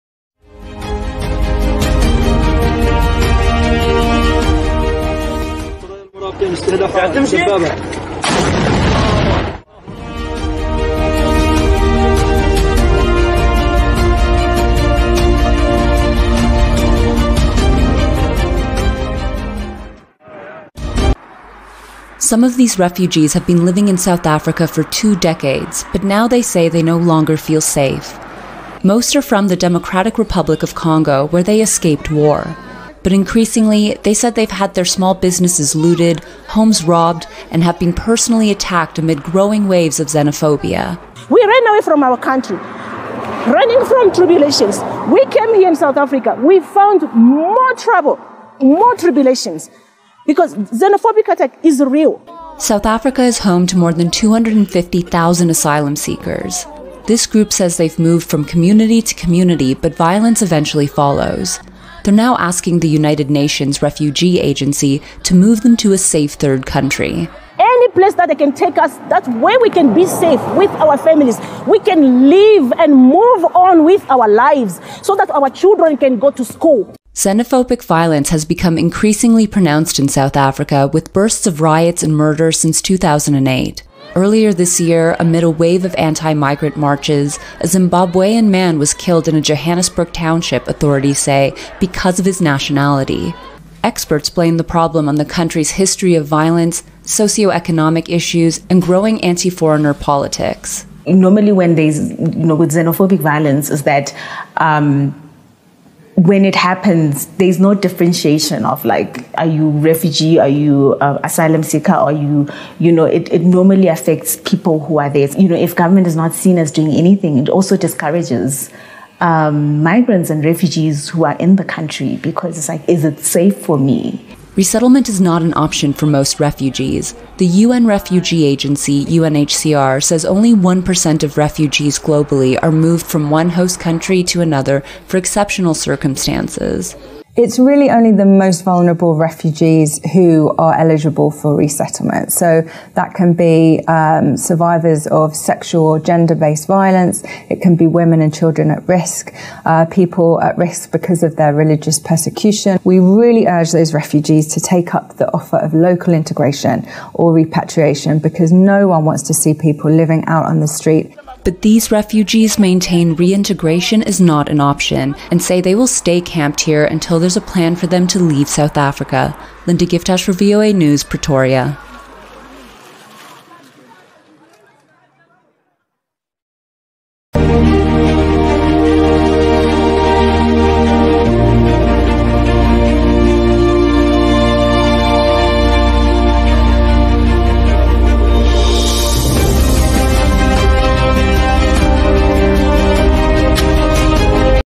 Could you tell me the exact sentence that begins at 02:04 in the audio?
Resettlement is not an option for most refugees.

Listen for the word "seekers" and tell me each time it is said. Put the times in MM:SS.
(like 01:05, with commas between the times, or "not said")
00:55, 01:51.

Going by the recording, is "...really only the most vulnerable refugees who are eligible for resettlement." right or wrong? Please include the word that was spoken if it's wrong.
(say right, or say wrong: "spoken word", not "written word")
right.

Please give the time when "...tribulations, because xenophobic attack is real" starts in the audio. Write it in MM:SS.
00:48.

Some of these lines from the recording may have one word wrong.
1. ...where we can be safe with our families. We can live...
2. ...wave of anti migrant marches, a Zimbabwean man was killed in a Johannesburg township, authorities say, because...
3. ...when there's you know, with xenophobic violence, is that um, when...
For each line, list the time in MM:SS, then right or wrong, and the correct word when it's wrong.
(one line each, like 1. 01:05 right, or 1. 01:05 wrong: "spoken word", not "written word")
1. 01:09 right
2. 01:25 right
3. 01:41 right.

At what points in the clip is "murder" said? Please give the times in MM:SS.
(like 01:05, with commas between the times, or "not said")
01:22.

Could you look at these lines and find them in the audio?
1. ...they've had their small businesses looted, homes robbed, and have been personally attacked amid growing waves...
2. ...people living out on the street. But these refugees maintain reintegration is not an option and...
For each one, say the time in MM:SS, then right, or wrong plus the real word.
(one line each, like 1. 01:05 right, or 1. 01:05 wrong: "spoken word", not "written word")
1. 00:34 right
2. 02:39 right.